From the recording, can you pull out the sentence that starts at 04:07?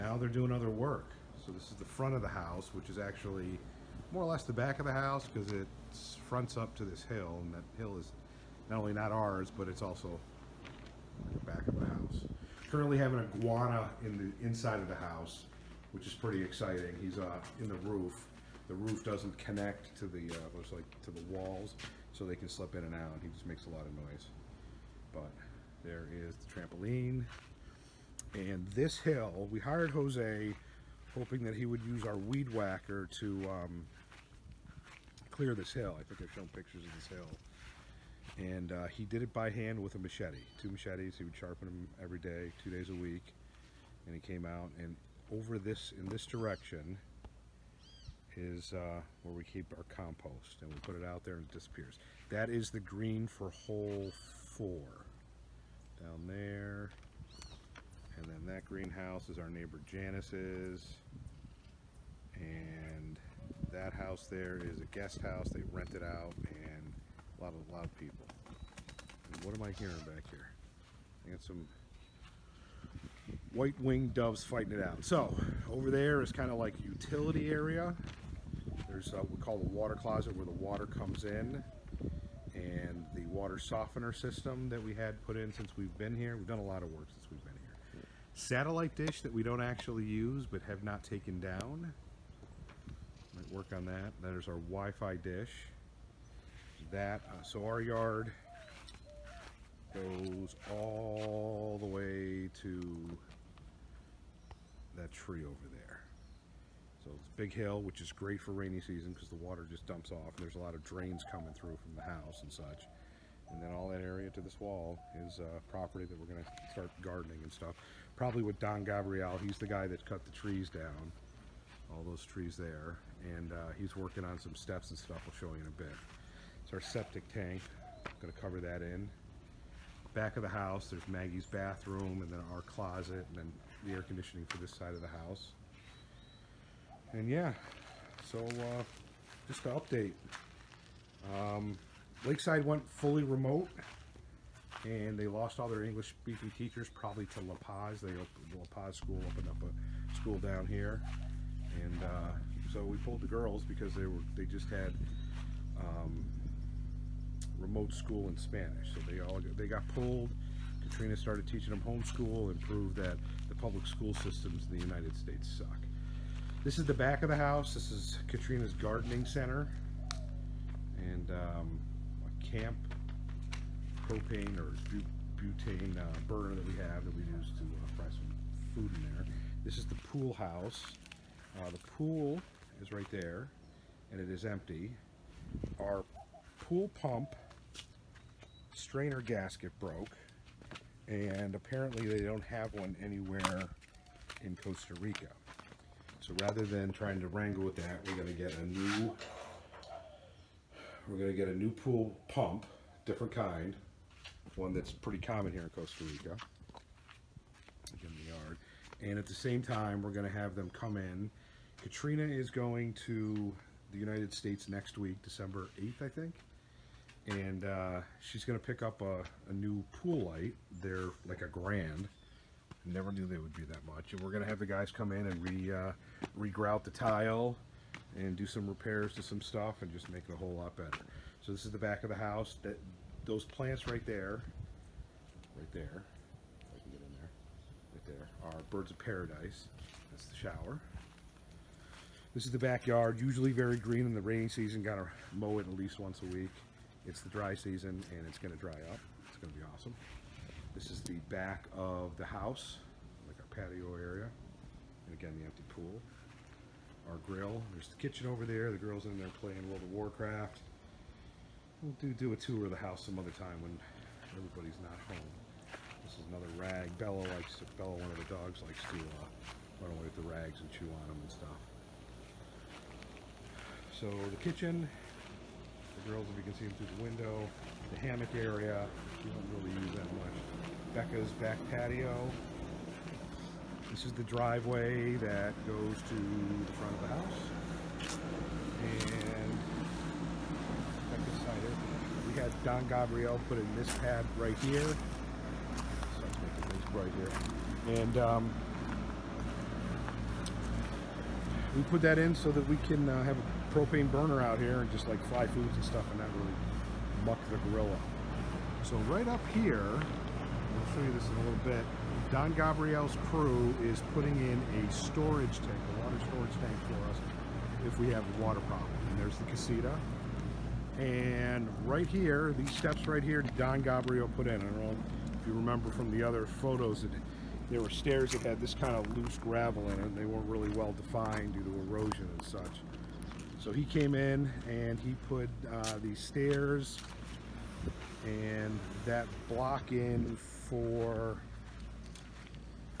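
It's the dry season and it's gonna dry up.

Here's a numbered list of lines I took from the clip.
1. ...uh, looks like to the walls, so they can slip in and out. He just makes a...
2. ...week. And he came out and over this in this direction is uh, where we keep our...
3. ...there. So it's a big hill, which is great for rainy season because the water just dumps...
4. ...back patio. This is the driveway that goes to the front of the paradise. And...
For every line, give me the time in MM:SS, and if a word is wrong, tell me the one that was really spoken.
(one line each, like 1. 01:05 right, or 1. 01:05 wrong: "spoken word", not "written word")
1. 00:20 right
2. 00:42 right
3. 01:45 right
4. 04:41 wrong: "house", not "paradise".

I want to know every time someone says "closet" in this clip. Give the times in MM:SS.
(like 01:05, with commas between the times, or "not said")
01:19, 02:12.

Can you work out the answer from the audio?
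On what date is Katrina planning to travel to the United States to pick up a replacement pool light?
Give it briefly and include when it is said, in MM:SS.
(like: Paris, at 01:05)
December 8th, at 03:35.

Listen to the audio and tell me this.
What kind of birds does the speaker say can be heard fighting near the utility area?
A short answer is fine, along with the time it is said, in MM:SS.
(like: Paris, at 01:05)
white winged doves, at 01:13.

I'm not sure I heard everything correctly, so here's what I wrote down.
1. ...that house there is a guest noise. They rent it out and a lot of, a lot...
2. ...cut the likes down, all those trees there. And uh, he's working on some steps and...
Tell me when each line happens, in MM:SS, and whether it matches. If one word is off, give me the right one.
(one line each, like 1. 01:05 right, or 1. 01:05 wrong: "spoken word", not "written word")
1. 01:03 wrong: "house", not "noise"
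2. 02:00 wrong: "trees", not "likes".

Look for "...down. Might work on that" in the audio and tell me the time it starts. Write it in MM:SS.
01:31.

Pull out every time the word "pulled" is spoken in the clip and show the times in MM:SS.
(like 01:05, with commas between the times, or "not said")
02:32, 02:39.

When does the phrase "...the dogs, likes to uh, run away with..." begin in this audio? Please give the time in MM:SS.
04:28.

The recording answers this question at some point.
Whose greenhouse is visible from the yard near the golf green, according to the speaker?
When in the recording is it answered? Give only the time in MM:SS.
00:59.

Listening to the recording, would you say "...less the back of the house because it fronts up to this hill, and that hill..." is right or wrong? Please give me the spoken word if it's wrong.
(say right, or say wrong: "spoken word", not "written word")
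right.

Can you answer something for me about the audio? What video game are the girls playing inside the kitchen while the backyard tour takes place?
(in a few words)
World of Warcraft.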